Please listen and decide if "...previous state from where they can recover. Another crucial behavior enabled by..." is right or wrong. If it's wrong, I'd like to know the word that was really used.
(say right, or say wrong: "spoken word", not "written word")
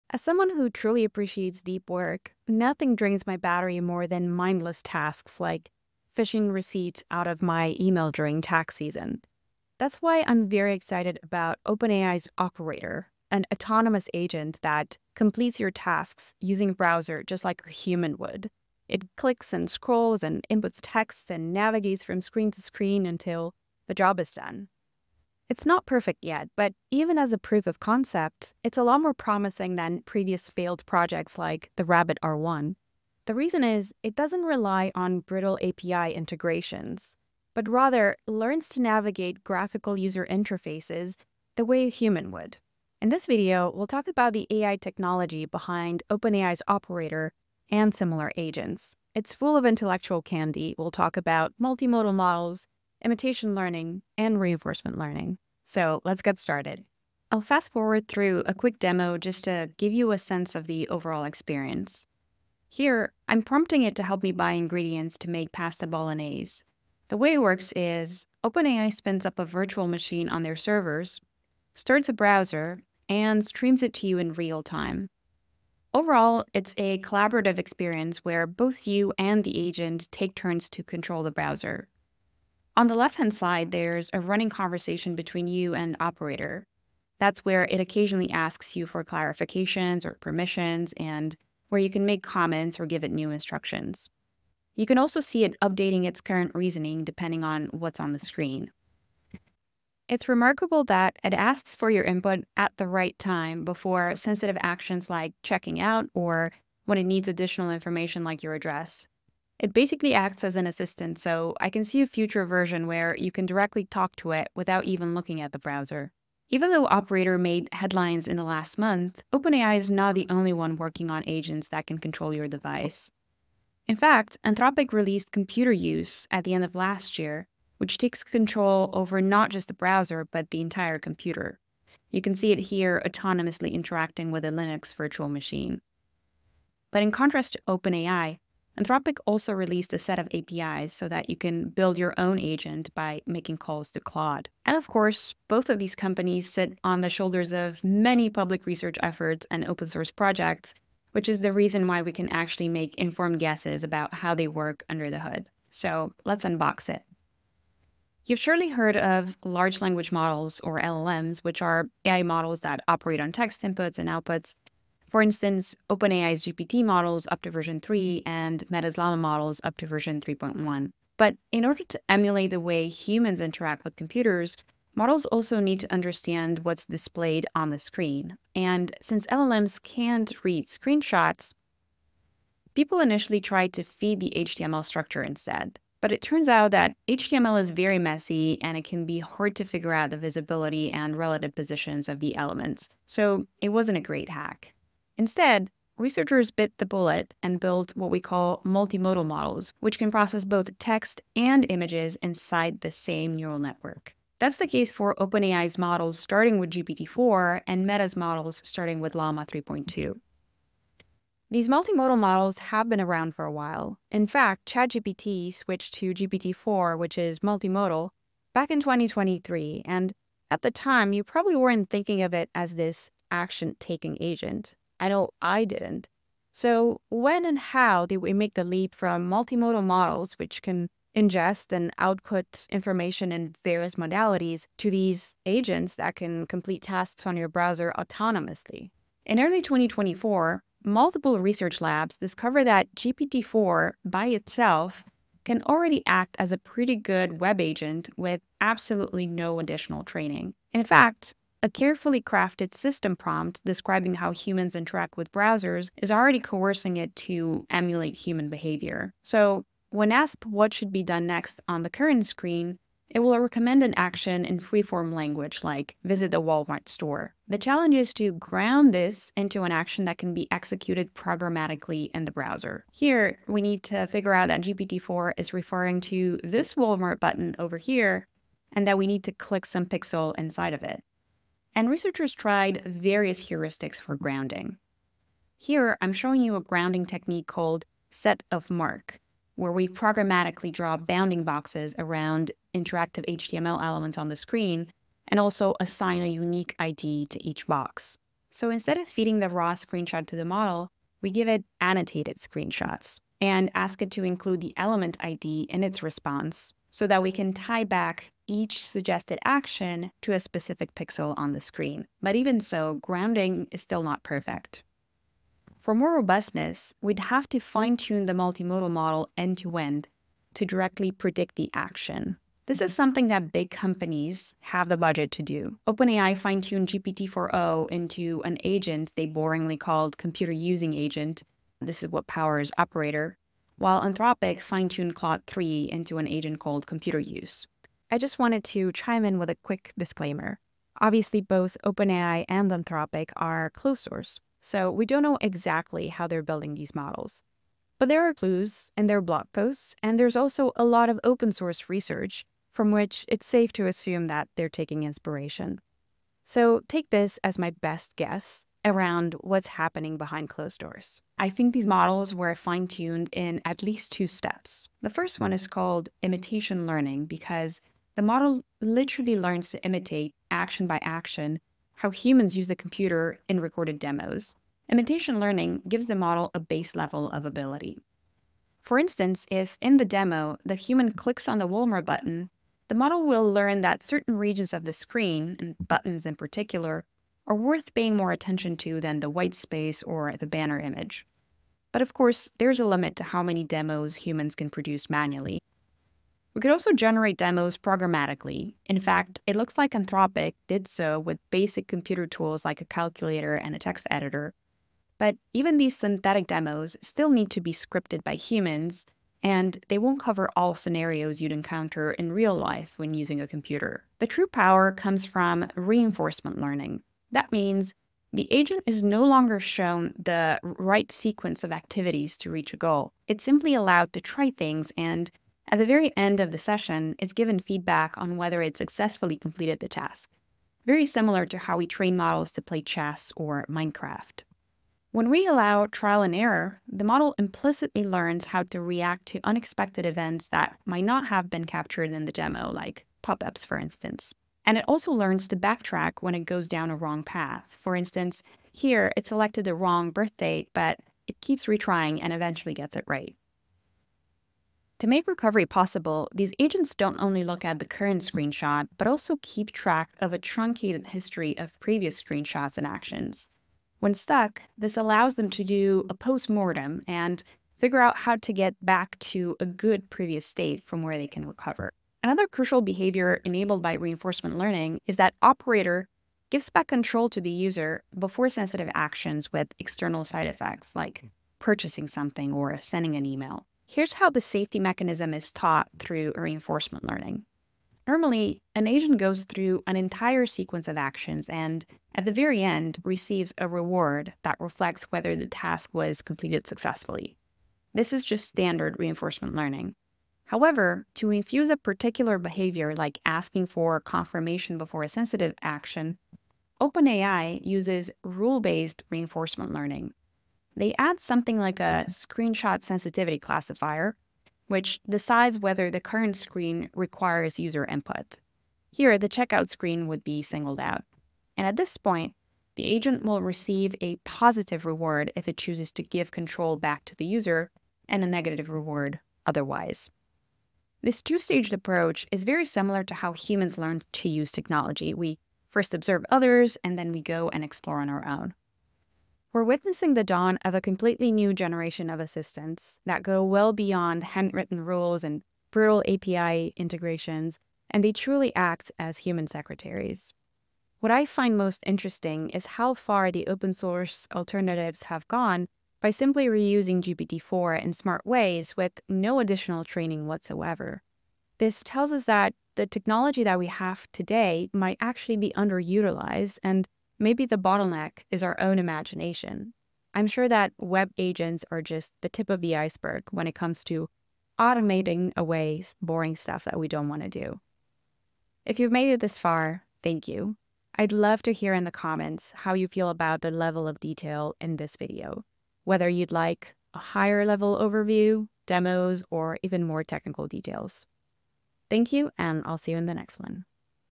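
right.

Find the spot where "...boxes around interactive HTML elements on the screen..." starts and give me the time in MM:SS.
04:51.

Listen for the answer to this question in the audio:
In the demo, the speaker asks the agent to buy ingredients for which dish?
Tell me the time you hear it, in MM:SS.
01:05.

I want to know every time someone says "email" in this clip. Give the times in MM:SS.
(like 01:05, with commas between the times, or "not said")
00:07, 08:03.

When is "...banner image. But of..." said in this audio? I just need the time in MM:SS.
06:30.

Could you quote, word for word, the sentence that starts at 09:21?
This tells us that the technology that we have today might actually be underutilized and Maybe the bottleneck is our own imagination.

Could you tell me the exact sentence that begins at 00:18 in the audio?
It clicks and scrolls and inputs text and navigates from screen to screen until the job is done.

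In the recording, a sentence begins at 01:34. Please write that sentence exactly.
You can also see it updating its current reasoning depending on what's on the screen.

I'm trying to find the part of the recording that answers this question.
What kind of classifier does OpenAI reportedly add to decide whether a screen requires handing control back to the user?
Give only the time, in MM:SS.
08:32.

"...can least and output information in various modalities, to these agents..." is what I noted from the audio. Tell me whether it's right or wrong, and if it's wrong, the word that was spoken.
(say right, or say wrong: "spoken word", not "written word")
wrong: "ingest", not "least".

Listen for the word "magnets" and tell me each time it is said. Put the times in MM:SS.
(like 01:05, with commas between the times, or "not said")
not said.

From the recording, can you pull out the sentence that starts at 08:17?
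This is just standard reinforcement learning.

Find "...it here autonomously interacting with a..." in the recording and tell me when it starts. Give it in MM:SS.
02:12.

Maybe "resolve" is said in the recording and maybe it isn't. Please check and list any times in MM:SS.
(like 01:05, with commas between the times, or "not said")
not said.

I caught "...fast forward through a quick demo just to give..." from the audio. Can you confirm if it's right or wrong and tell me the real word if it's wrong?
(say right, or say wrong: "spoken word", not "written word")
right.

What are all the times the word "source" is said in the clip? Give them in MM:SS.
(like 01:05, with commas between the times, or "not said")
02:29, 05:44, 05:51, 09:13.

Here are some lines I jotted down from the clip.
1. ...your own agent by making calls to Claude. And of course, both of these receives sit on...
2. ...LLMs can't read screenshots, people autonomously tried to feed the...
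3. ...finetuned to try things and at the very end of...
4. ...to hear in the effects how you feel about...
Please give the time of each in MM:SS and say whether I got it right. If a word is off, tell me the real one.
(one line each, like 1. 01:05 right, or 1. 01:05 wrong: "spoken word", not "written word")
1. 02:21 wrong: "companies", not "receives"
2. 02:59 wrong: "initially", not "autonomously"
3. 07:03 wrong: "allowed", not "finetuned"
4. 09:41 wrong: "comments", not "effects".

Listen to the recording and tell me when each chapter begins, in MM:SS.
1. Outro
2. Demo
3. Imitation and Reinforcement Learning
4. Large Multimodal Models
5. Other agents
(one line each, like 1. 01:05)
1. 09:01
2. 00:57
3. 05:38
4. 03:16
5. 01:57.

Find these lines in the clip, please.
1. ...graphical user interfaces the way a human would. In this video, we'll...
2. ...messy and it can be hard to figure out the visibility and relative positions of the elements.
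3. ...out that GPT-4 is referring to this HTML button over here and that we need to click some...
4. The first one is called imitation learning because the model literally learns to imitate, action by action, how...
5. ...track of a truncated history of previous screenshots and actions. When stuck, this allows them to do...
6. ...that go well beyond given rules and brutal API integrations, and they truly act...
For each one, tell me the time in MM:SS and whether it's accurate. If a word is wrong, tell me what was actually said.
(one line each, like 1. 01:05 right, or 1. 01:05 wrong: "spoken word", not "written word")
1. 00:39 right
2. 03:07 right
3. 04:34 wrong: "Walmart", not "HTML"
4. 06:05 right
5. 07:39 right
6. 09:03 wrong: "handwritten", not "given".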